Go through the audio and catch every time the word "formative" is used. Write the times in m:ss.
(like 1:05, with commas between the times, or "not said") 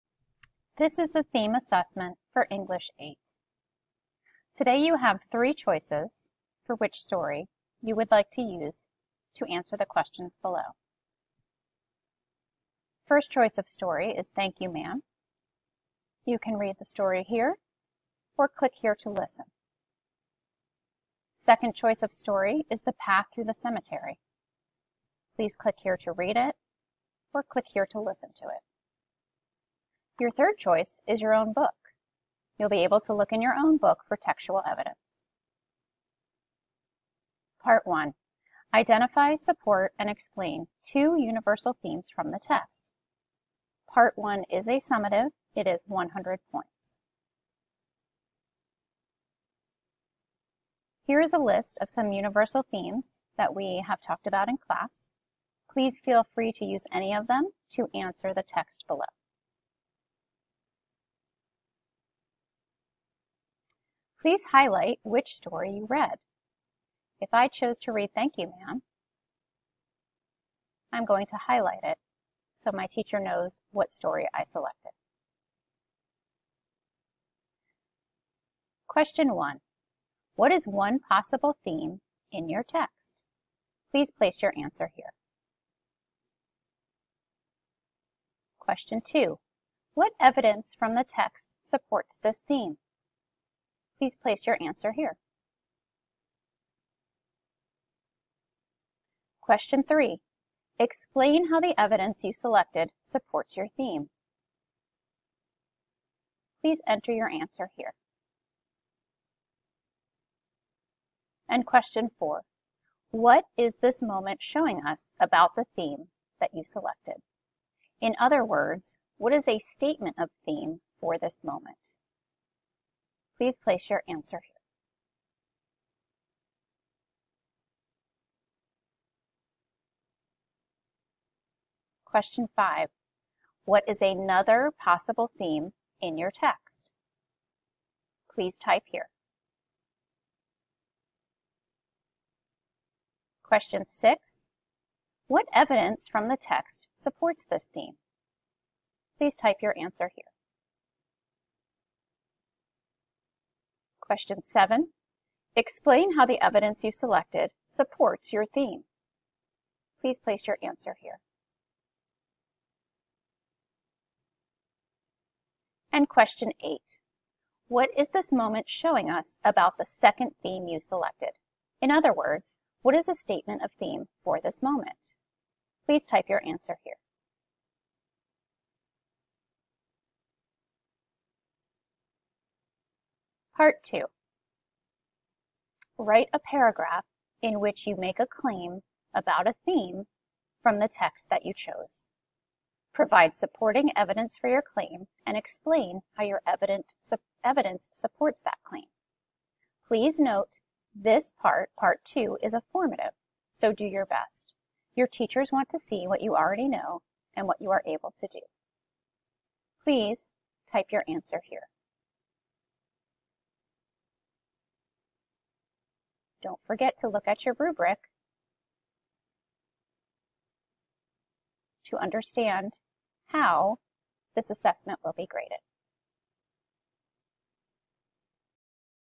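3:22.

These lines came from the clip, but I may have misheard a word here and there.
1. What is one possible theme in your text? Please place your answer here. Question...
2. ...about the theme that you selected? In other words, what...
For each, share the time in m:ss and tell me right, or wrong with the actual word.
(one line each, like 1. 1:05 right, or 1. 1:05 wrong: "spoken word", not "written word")
1. 1:20 right
2. 1:55 right.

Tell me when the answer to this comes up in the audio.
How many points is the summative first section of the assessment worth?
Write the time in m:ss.
0:45.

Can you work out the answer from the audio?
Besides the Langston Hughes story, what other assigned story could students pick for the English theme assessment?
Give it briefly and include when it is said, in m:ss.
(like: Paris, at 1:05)
The Path Through the Cemetery, at 0:22.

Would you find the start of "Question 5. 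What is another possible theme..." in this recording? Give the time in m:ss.
2:12.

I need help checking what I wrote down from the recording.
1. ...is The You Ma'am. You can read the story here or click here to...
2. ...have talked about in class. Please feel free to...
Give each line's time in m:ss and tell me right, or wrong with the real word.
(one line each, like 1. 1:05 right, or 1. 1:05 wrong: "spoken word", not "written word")
1. 0:14 wrong: "Thank", not "The"
2. 0:53 right.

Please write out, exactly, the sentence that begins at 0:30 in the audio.
Your third choice is your own book.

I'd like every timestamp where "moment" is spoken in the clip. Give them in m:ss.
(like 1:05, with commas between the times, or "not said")
1:54, 2:01, 2:48, 2:54.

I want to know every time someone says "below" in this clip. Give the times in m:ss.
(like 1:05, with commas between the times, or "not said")
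0:10, 0:58.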